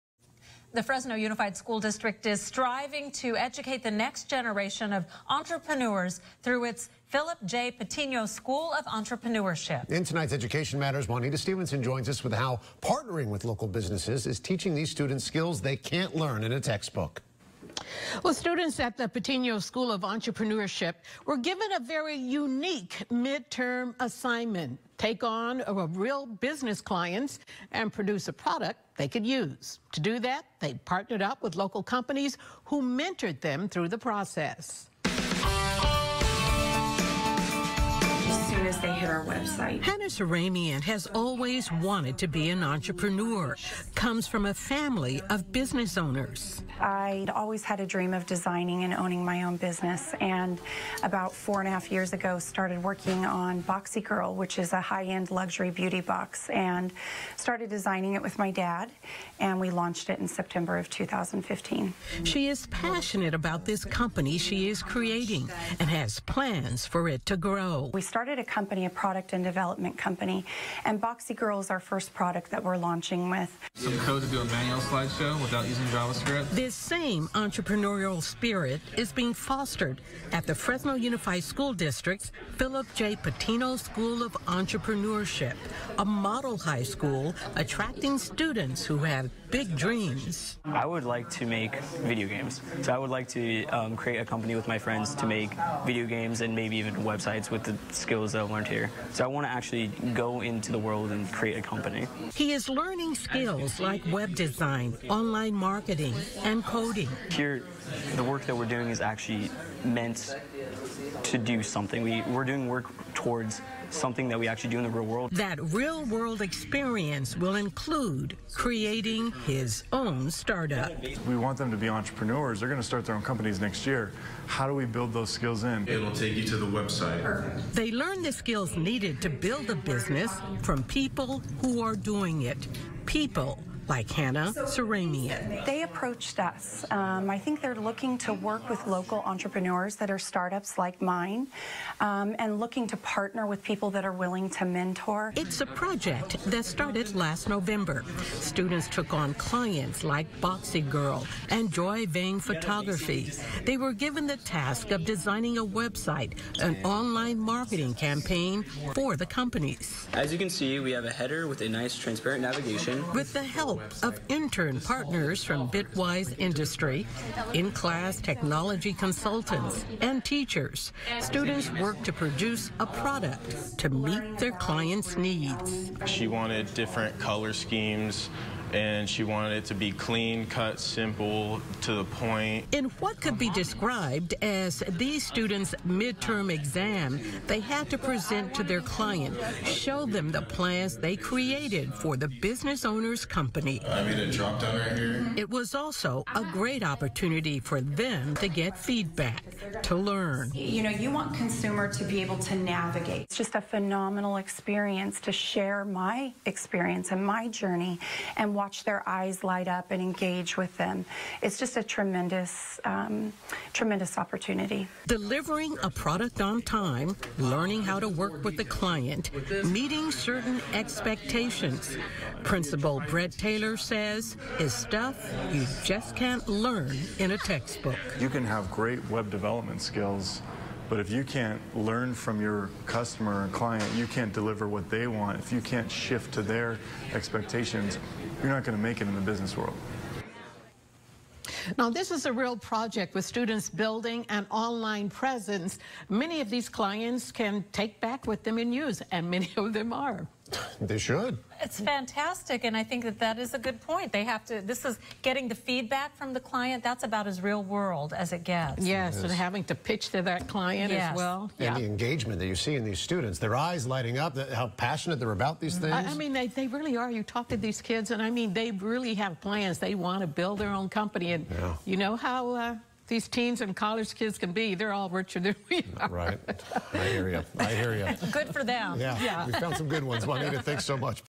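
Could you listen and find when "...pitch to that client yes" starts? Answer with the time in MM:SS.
04:19.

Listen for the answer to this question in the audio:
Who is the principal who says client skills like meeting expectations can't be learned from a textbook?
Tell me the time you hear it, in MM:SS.
03:43.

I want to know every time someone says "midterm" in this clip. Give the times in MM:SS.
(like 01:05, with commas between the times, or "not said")
00:23, 03:05.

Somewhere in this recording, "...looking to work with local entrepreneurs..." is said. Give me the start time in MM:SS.
02:17.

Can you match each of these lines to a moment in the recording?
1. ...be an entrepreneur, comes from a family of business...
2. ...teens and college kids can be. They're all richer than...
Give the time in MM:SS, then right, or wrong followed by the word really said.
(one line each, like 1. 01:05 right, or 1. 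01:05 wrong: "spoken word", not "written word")
1. 00:42 right
2. 04:33 right.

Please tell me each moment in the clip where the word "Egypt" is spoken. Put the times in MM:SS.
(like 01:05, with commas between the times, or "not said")
not said.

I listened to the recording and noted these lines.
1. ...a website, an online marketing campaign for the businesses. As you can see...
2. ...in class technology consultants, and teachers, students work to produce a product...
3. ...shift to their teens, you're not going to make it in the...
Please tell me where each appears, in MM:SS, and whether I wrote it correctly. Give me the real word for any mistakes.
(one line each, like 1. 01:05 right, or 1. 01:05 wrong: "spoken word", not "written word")
1. 02:35 wrong: "companies", not "businesses"
2. 02:47 right
3. 03:55 wrong: "expectations", not "teens".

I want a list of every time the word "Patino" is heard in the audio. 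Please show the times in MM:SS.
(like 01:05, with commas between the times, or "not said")
00:07, 00:19, 01:23.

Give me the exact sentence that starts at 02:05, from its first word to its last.
It'll take you to the website.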